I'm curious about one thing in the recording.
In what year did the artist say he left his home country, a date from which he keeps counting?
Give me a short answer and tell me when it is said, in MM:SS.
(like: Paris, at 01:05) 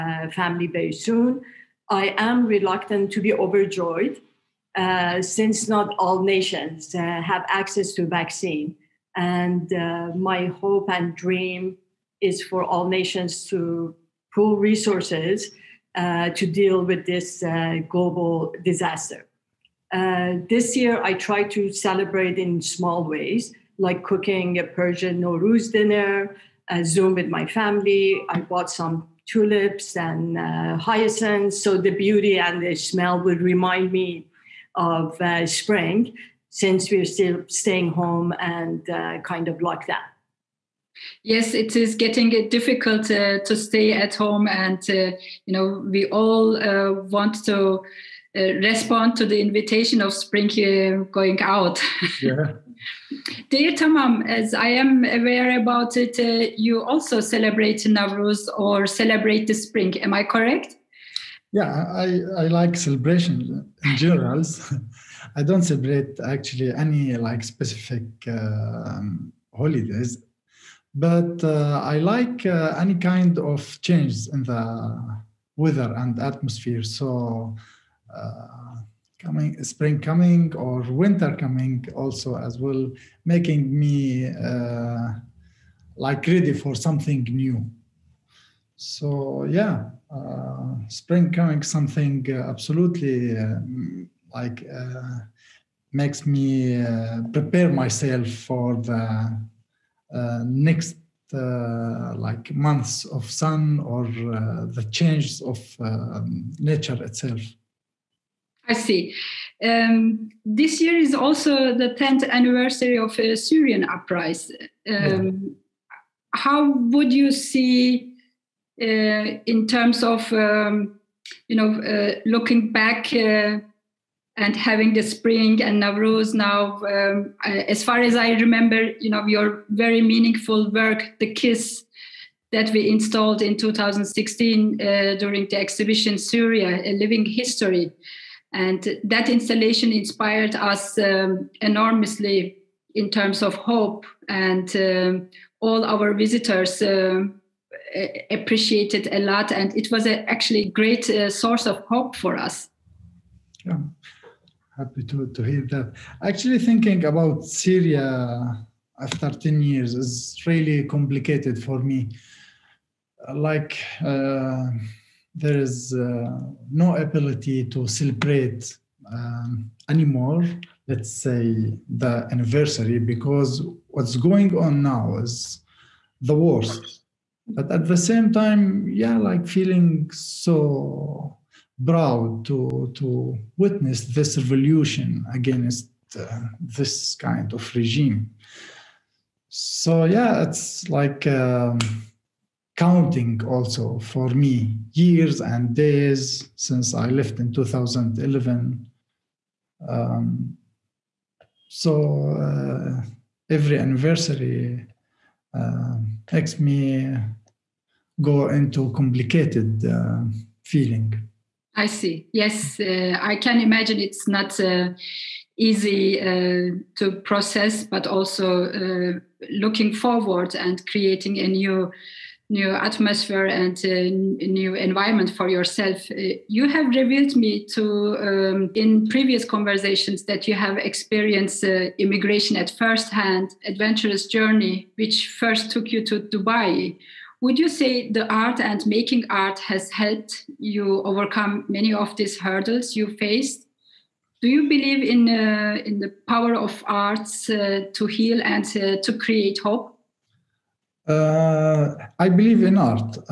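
2011, at 03:17.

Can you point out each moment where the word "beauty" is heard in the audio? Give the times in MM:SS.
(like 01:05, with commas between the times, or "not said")
00:31.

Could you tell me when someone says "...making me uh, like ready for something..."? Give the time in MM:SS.
01:23.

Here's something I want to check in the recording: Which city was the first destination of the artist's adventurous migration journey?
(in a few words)
Dubai.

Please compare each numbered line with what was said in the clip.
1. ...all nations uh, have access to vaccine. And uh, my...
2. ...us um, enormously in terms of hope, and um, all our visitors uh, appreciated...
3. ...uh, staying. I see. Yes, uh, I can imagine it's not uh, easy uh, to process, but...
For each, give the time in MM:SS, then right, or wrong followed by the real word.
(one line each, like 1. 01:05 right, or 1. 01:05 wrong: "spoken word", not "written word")
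1. 00:05 right
2. 02:20 right
3. 03:29 wrong: "feeling", not "staying".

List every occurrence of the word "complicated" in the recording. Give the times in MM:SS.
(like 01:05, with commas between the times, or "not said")
02:40, 03:28.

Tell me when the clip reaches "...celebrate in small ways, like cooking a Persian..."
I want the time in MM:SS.
00:21.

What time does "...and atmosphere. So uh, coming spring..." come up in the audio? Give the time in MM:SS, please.
01:15.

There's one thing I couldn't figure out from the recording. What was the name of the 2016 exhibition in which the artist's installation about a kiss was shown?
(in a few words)
Syria: A Living History.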